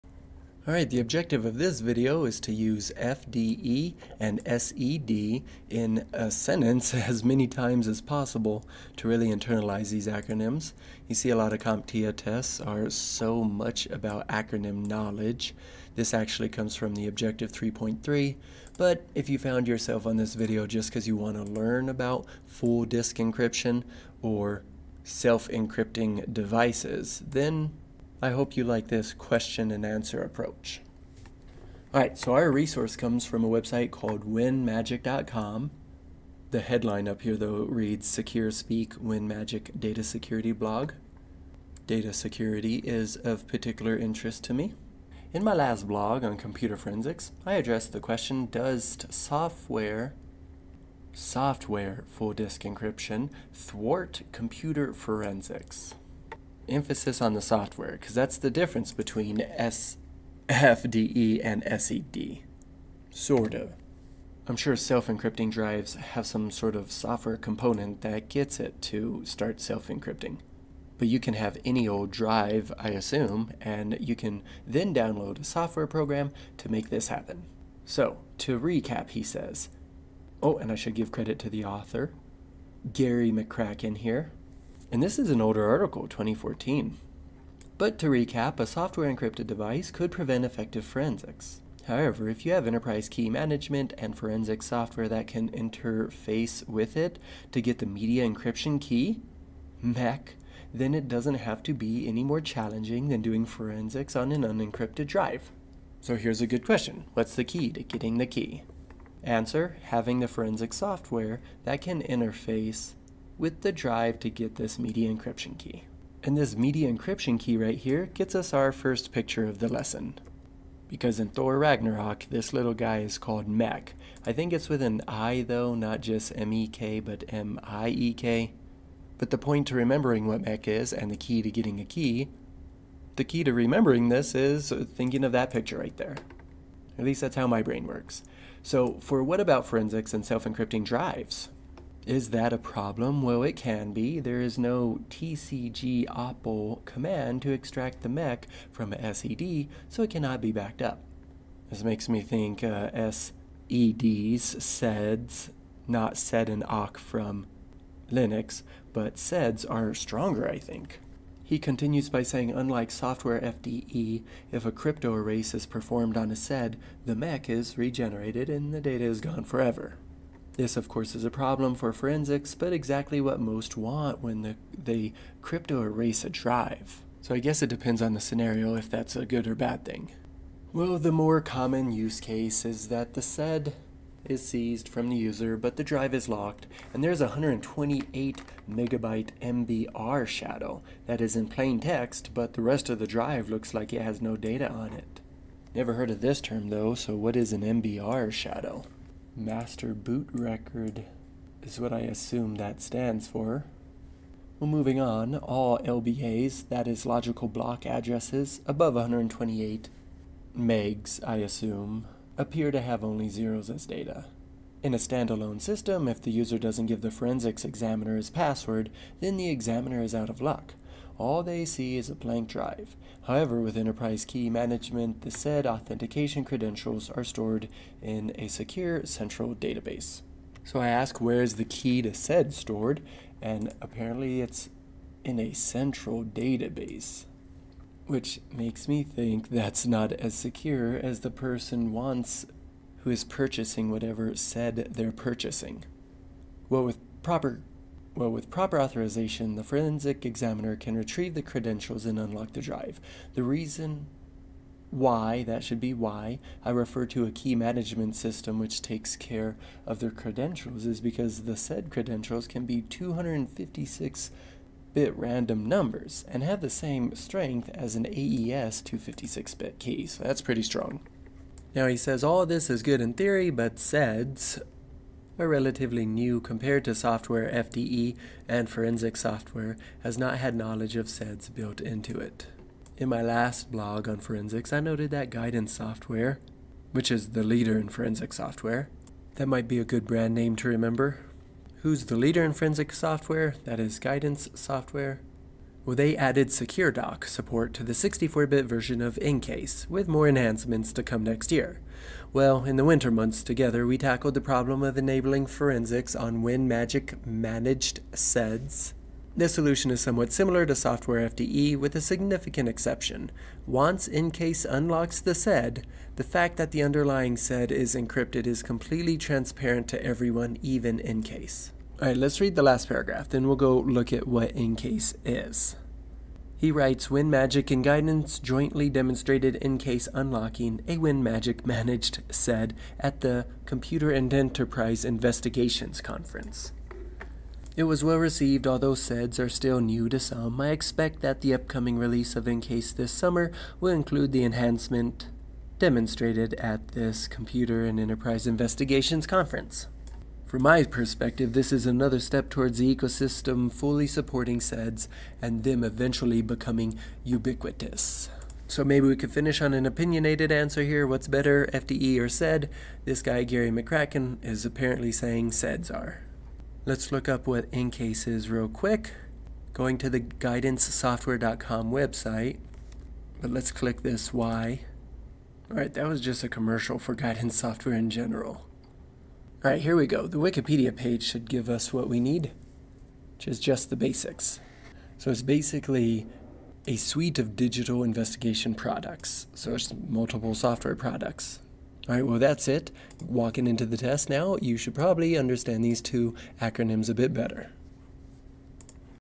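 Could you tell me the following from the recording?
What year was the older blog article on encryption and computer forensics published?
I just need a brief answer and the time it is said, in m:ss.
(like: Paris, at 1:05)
2014, at 1:26.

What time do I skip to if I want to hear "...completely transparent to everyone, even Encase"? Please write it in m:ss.
5:18.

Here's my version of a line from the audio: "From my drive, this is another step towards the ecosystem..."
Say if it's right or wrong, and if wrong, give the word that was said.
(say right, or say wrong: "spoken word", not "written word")
wrong: "perspective", not "drive".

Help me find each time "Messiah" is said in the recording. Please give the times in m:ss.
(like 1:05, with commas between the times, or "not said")
not said.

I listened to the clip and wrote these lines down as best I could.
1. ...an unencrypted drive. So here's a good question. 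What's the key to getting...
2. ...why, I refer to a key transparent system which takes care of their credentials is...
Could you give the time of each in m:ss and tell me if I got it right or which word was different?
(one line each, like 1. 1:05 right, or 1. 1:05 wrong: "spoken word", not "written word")
1. 1:44 right
2. 4:15 wrong: "management", not "transparent".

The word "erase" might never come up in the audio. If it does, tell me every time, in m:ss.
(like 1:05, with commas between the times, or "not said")
2:45, 2:55.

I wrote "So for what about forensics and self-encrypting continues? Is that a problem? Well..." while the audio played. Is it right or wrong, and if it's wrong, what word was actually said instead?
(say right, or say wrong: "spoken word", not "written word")
wrong: "drives", not "continues".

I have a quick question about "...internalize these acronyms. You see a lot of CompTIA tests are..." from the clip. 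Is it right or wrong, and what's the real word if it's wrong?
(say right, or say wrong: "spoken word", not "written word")
right.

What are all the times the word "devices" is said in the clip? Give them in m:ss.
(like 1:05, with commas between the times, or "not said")
0:26, 1:29.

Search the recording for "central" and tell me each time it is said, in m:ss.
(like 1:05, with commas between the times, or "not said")
3:49, 3:55.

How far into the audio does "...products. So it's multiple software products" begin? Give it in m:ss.
6:28.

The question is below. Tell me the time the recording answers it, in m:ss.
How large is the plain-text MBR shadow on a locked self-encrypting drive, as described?
3:07.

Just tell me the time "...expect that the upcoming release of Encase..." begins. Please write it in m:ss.
5:40.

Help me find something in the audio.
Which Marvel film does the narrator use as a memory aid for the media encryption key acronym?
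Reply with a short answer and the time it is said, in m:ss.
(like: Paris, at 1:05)
Thor Ragnarok, at 2:01.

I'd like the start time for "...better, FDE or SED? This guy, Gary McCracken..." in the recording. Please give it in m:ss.
6:01.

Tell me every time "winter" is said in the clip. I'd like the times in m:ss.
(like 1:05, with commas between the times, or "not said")
5:02.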